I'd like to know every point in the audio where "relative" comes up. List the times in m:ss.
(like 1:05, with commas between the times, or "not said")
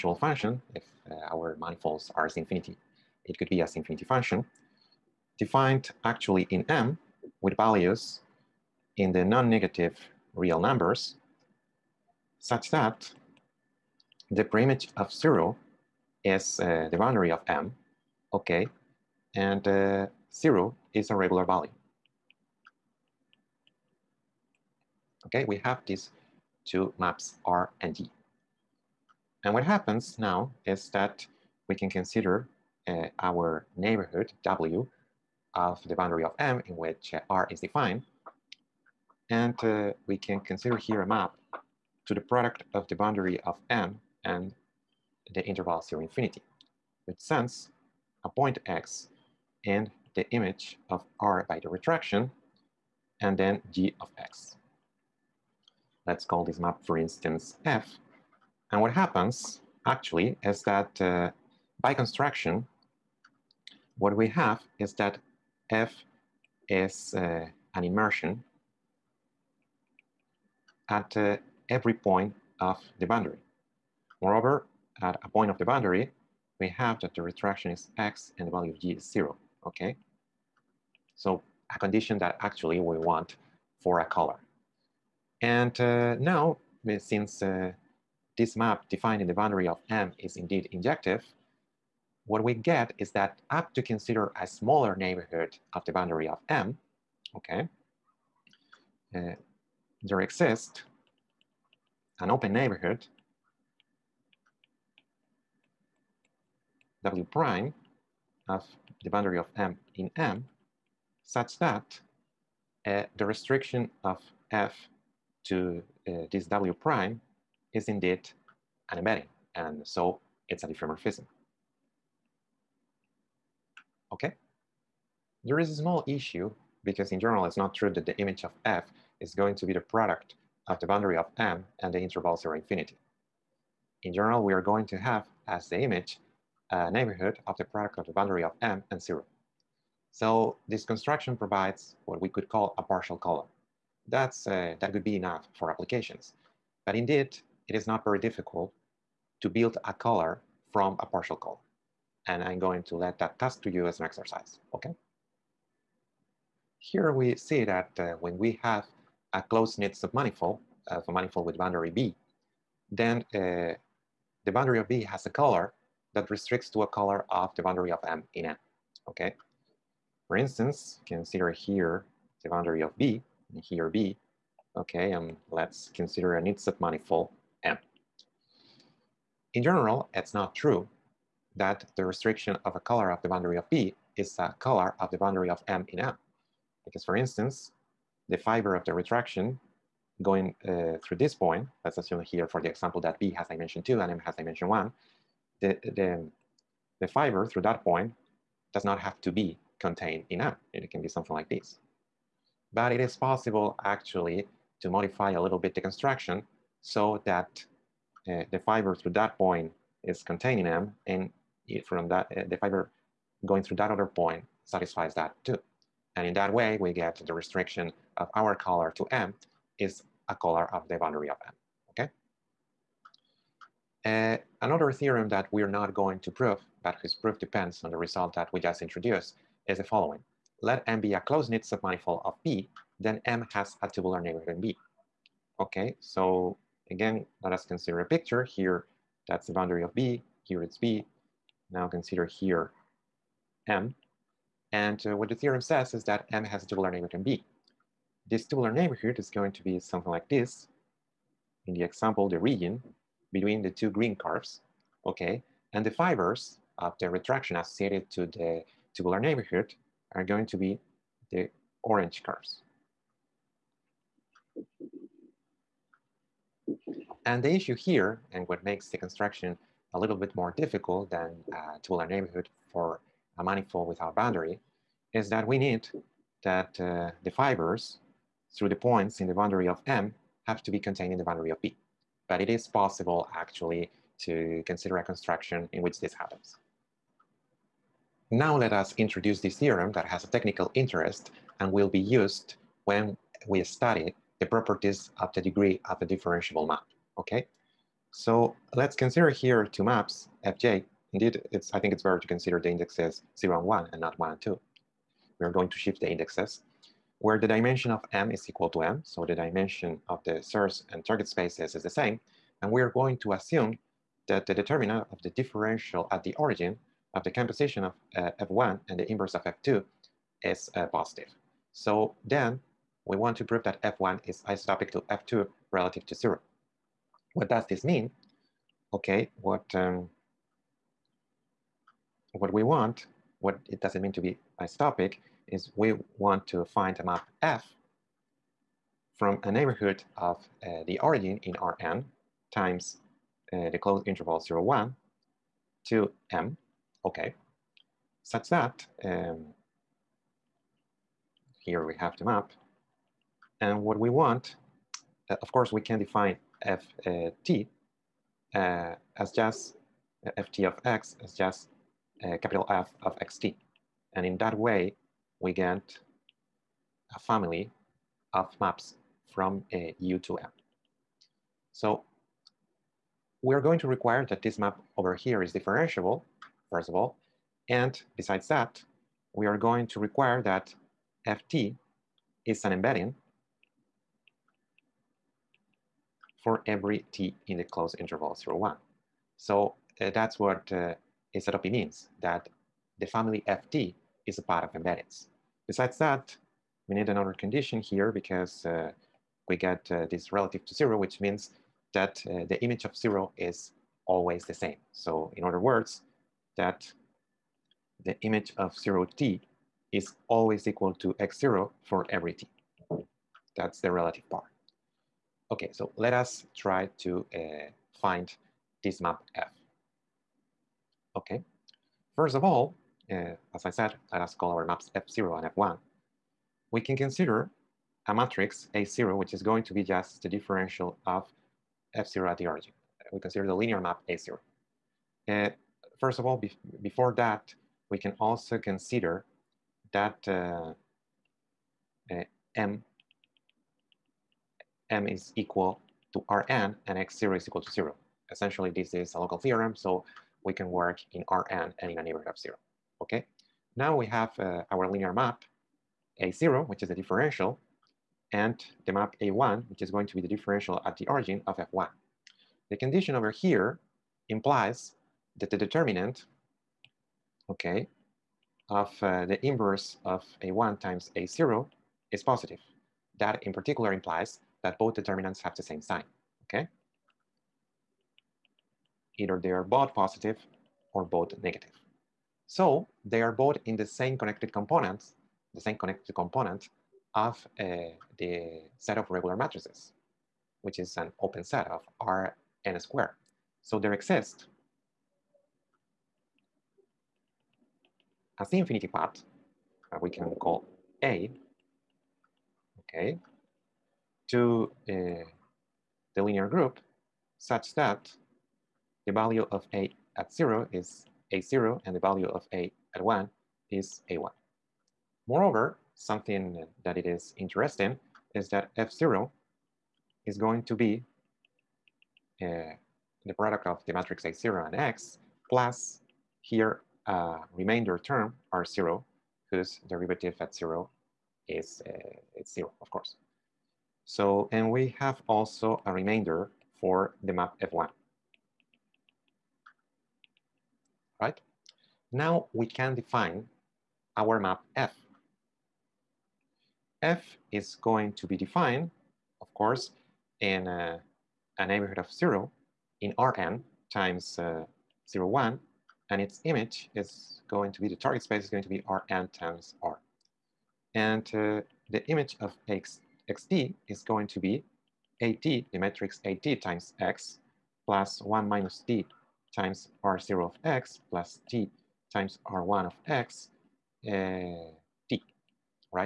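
5:25, 6:40, 6:53.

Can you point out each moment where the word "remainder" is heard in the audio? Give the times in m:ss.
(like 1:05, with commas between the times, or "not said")
8:47, 8:55.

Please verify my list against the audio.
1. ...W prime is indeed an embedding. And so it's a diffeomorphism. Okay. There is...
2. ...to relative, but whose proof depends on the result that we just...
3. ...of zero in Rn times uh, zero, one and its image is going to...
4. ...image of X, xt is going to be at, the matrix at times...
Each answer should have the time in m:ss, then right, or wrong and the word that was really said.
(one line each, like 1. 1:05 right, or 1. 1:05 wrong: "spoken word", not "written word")
1. 1:56 right
2. 3:46 wrong: "prove", not "relative"
3. 9:11 right
4. 9:22 right.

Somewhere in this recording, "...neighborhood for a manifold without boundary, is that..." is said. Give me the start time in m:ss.
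4:32.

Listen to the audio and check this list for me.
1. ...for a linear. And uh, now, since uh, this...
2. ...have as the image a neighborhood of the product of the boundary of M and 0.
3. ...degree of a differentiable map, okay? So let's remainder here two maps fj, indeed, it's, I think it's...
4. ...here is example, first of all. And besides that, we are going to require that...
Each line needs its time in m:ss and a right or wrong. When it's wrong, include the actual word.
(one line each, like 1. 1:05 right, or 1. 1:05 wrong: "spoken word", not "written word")
1. 1:23 wrong: "collar", not "linear"
2. 2:14 right
3. 4:55 wrong: "consider", not "remainder"
4. 6:15 wrong: "differentiable", not "example".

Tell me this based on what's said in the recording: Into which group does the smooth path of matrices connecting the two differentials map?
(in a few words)
the linear group.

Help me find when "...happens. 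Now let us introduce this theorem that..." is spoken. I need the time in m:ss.
4:46.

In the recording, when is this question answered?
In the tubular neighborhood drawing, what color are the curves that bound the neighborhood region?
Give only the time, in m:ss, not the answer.
4:13.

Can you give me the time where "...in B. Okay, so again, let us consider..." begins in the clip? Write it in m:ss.
3:54.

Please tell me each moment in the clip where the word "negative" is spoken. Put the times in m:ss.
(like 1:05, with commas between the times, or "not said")
0:09, 8:01.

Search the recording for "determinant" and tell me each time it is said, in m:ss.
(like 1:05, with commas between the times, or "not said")
5:14, 7:45, 7:54.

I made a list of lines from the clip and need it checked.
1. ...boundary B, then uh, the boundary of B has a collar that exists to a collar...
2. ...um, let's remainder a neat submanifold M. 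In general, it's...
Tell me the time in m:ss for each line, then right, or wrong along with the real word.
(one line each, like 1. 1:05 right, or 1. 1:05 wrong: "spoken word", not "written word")
1. 2:41 wrong: "restricts", not "exists"
2. 2:55 wrong: "consider", not "remainder".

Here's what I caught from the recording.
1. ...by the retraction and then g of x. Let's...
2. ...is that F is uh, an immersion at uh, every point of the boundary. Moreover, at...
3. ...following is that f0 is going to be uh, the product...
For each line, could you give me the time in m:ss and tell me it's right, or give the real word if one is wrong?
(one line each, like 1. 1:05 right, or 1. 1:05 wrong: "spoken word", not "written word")
1. 0:51 right
2. 1:04 right
3. 8:37 wrong: "interesting", not "following".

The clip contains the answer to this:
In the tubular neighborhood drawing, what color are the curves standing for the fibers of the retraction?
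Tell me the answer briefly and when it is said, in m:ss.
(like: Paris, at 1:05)
orange, at 4:21.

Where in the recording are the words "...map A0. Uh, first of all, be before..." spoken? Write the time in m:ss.
7:13.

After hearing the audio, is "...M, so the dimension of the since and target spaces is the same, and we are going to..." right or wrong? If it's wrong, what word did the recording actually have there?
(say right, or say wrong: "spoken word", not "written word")
wrong: "source", not "since".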